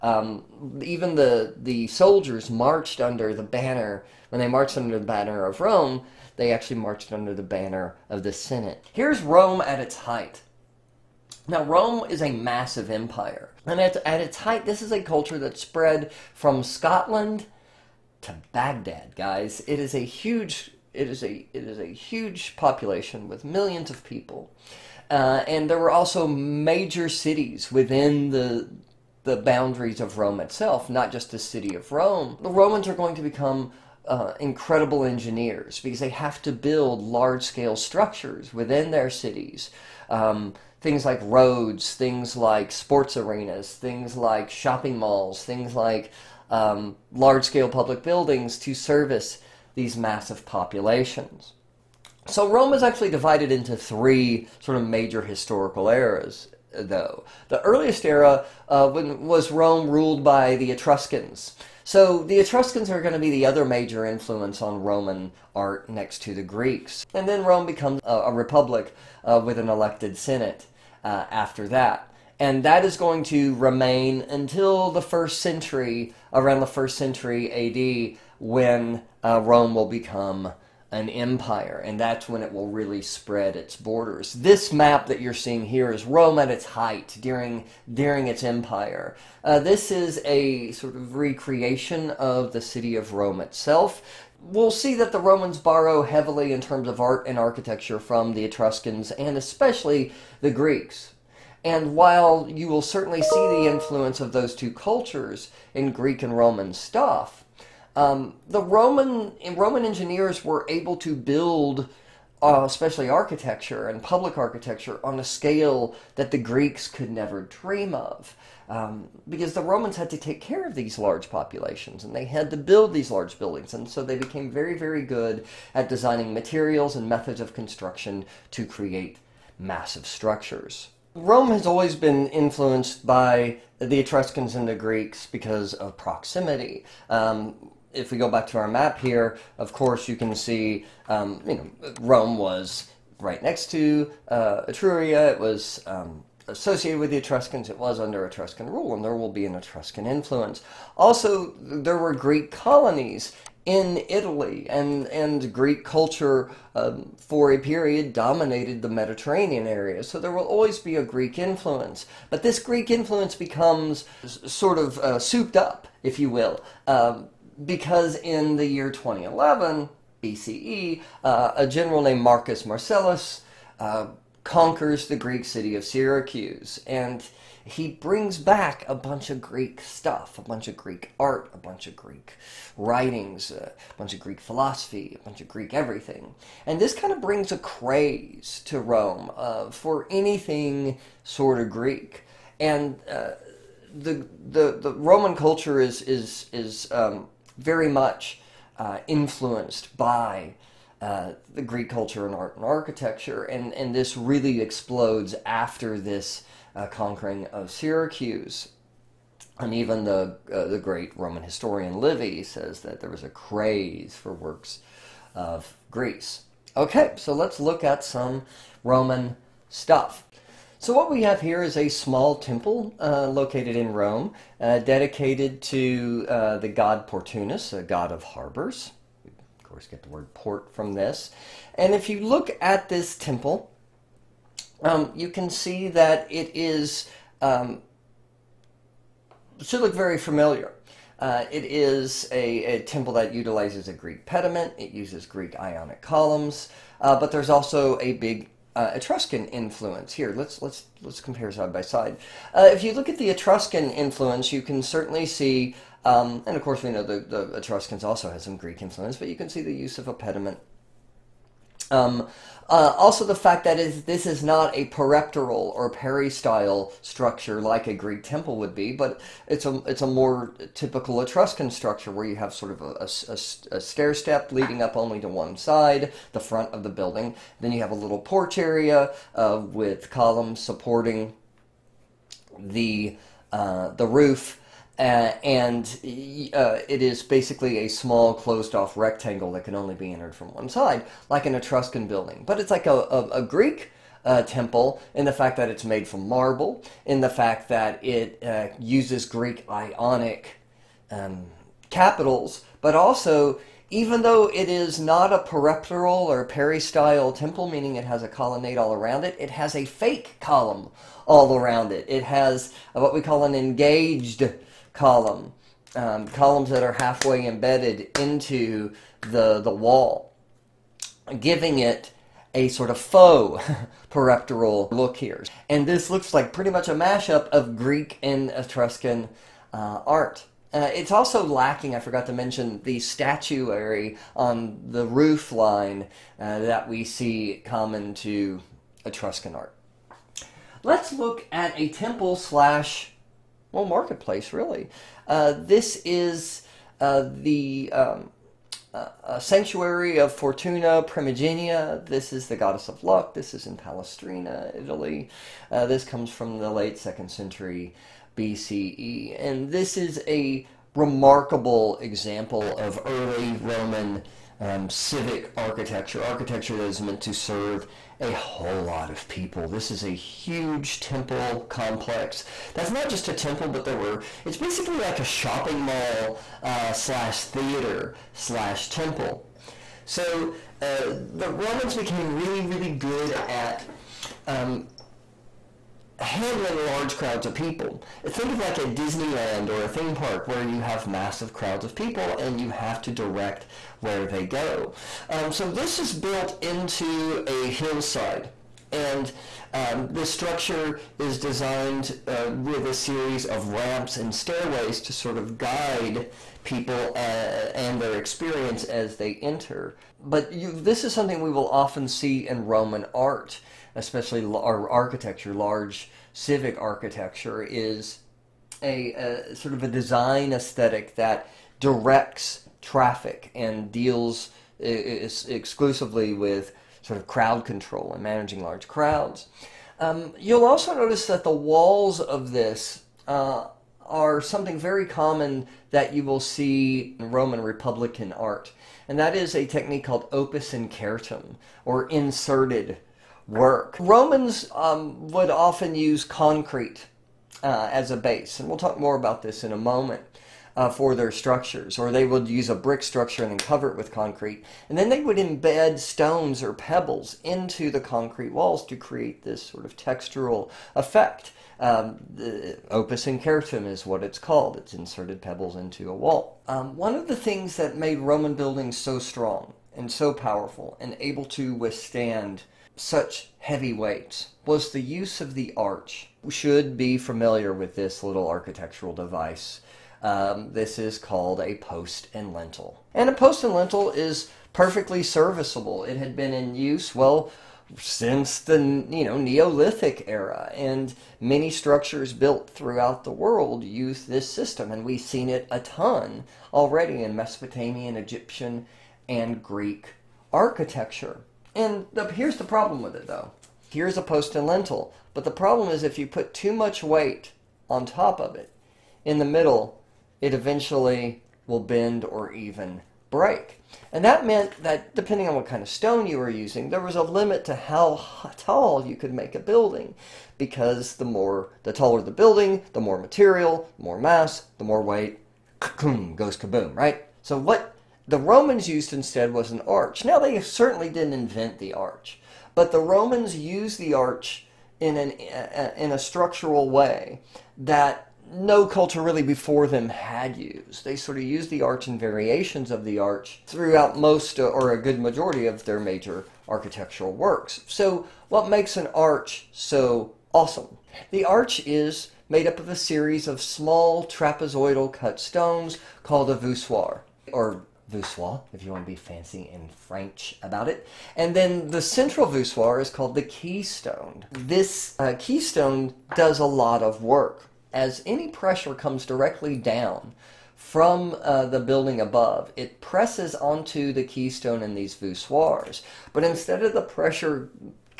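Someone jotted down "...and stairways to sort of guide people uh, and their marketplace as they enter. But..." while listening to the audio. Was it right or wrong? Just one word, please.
wrong.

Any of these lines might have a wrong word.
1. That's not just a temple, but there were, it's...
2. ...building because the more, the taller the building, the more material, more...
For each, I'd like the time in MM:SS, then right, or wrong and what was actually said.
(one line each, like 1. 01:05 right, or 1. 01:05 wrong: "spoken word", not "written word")
1. 06:12 right
2. 08:39 right.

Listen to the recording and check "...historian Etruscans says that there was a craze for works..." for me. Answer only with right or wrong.
wrong.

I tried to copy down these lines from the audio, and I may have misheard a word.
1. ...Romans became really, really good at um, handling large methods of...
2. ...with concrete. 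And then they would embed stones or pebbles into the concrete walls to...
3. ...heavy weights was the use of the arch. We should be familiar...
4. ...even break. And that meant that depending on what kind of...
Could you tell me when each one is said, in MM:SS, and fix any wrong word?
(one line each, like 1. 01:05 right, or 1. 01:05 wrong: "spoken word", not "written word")
1. 06:21 wrong: "crowds", not "methods"
2. 07:33 right
3. 07:53 right
4. 08:32 right.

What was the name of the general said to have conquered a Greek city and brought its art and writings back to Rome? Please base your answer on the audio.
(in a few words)
Marcus Marcellus.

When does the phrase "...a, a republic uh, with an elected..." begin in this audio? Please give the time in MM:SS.
01:08.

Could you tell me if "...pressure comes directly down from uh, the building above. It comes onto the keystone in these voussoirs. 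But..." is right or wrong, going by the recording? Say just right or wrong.
wrong.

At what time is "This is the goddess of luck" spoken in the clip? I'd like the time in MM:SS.
05:52.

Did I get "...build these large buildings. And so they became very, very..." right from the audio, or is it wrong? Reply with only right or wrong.
right.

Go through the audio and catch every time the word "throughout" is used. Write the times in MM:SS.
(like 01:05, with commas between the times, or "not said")
08:12, 09:03.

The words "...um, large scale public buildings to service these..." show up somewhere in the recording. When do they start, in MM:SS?
00:46.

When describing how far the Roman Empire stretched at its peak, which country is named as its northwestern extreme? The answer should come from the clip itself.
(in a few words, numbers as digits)
Scotland.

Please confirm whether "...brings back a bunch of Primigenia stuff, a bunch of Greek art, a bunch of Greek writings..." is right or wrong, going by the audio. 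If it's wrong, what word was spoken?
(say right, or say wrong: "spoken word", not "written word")
wrong: "Greek", not "Primigenia".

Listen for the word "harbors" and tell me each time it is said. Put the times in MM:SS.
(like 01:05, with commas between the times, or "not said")
03:48.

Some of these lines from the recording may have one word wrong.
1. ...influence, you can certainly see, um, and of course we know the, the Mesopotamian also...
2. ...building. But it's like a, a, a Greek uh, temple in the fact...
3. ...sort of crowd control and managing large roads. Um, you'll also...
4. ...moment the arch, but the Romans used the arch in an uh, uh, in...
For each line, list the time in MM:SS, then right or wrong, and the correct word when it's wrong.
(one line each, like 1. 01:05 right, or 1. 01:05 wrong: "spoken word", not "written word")
1. 04:13 wrong: "Etruscans", not "Mesopotamian"
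2. 04:52 right
3. 07:07 wrong: "crowds", not "roads"
4. 08:51 wrong: "invent", not "moment".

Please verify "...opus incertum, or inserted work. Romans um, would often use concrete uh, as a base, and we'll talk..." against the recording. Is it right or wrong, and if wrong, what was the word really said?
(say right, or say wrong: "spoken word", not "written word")
right.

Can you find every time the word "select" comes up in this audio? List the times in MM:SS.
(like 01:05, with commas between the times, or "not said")
not said.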